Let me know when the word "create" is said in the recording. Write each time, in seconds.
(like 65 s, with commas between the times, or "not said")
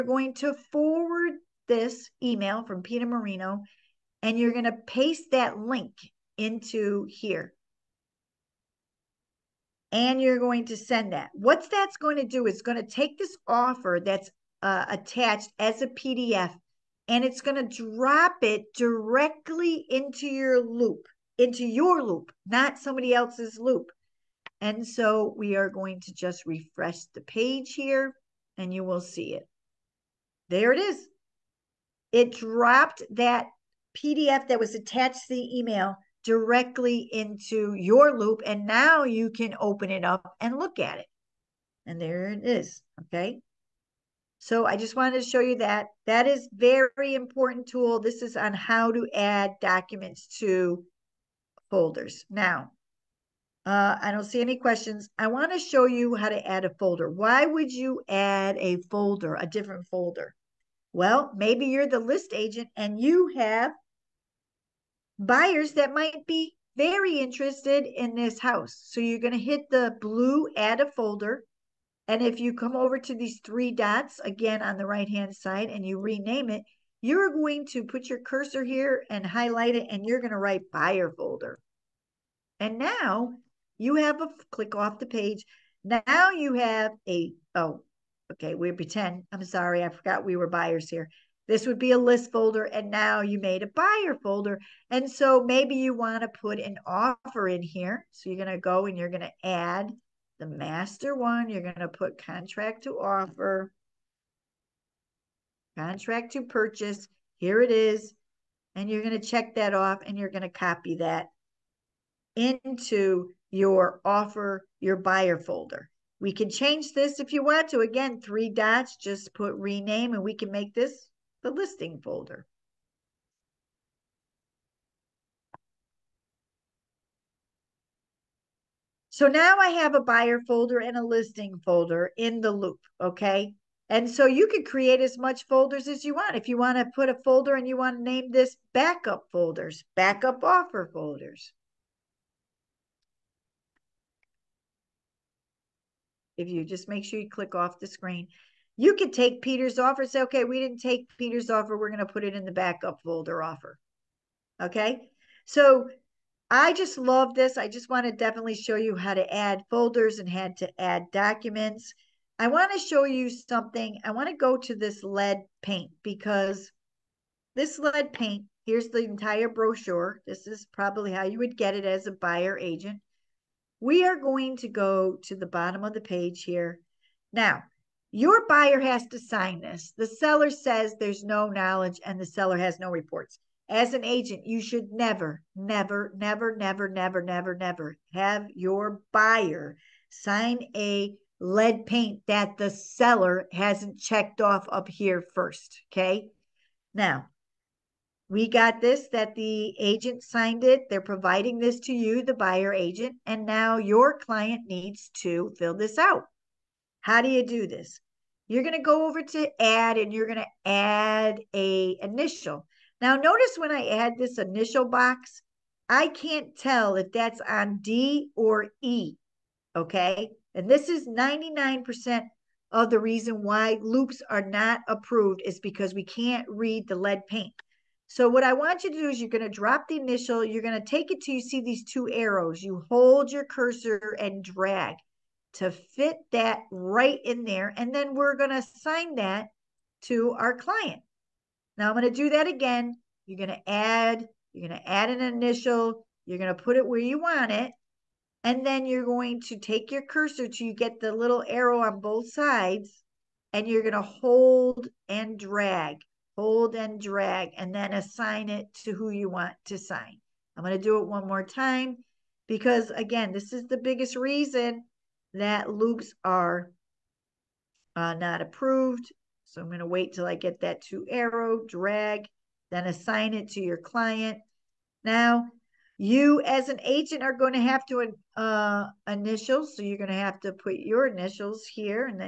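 134 s.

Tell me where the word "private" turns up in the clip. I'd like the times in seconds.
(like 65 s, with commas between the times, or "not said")
not said.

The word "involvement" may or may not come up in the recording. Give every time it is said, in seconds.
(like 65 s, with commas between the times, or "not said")
not said.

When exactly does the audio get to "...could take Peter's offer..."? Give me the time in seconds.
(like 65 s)
148 s.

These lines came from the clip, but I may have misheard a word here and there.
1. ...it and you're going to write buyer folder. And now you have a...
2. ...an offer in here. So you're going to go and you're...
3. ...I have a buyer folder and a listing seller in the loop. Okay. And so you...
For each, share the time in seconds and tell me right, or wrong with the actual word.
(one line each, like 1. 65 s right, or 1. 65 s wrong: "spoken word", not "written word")
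1. 79 s right
2. 96 s right
3. 129 s wrong: "folder", not "seller".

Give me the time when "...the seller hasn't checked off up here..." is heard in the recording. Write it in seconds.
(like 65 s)
192 s.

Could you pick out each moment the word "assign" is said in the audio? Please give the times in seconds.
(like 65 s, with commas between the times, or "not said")
238 s, 257 s, 272 s.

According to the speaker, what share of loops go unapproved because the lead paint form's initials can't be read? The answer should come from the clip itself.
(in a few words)
99%.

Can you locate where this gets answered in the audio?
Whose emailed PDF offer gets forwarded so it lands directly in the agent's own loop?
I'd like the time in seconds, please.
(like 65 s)
2 s.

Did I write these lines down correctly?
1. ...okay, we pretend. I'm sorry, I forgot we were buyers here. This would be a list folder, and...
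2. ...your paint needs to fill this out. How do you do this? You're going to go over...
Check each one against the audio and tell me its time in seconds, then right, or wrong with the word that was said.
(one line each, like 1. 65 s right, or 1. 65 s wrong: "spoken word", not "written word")
1. 88 s right
2. 203 s wrong: "client", not "paint".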